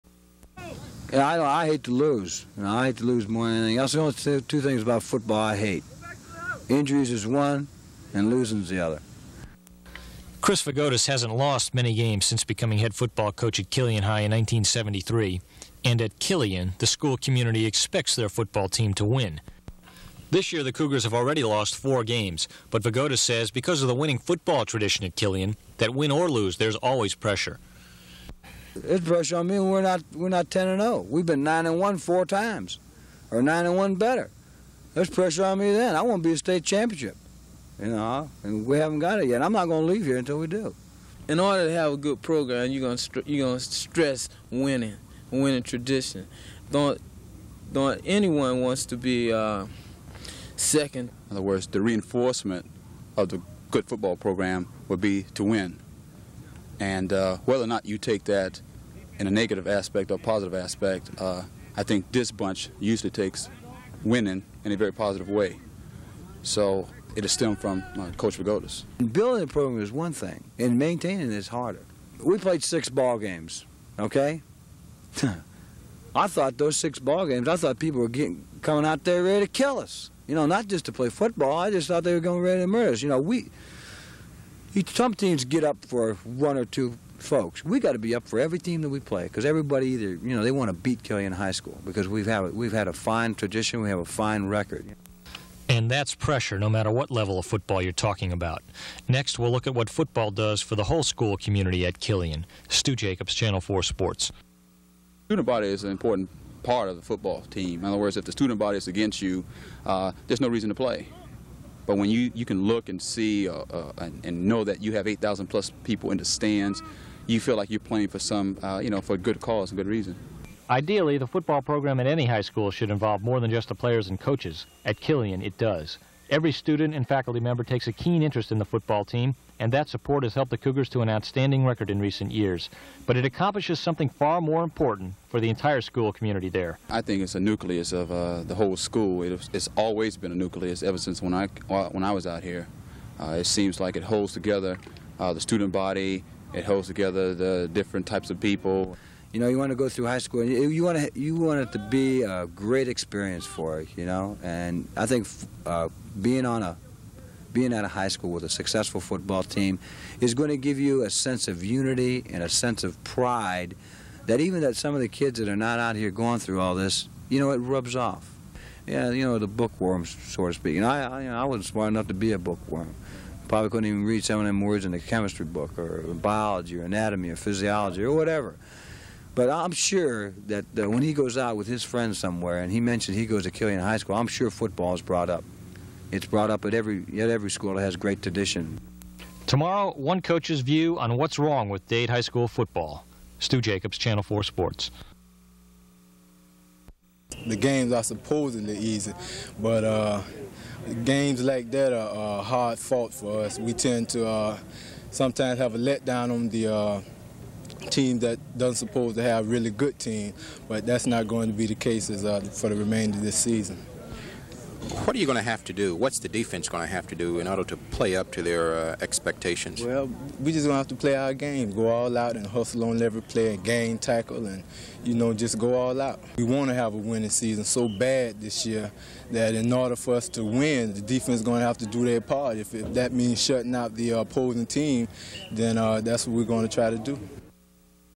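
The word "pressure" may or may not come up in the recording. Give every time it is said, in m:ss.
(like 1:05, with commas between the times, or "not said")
0:27, 0:35, 1:36.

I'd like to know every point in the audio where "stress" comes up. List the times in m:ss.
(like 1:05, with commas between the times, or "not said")
0:43.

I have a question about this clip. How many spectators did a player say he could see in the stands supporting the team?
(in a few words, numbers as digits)
8,000 plus.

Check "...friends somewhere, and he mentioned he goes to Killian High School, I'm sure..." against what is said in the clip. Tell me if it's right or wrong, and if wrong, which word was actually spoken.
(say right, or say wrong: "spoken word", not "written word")
right.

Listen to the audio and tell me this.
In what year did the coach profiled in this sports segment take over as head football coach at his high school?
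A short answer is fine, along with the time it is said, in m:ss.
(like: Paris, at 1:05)
1973, at 0:14.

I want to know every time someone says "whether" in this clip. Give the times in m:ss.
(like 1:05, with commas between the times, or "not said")
0:57.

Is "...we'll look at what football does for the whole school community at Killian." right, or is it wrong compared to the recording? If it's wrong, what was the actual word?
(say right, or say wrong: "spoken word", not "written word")
right.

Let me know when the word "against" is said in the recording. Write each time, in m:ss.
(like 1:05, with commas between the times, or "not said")
1:48.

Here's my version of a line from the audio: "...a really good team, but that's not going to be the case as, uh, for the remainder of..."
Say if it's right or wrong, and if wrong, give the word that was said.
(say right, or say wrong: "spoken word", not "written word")
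right.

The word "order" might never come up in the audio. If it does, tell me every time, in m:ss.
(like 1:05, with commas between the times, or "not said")
0:41, 3:37, 3:49.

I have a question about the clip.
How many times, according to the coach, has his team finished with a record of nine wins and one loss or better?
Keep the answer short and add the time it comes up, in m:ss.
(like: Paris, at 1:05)
4, at 0:31.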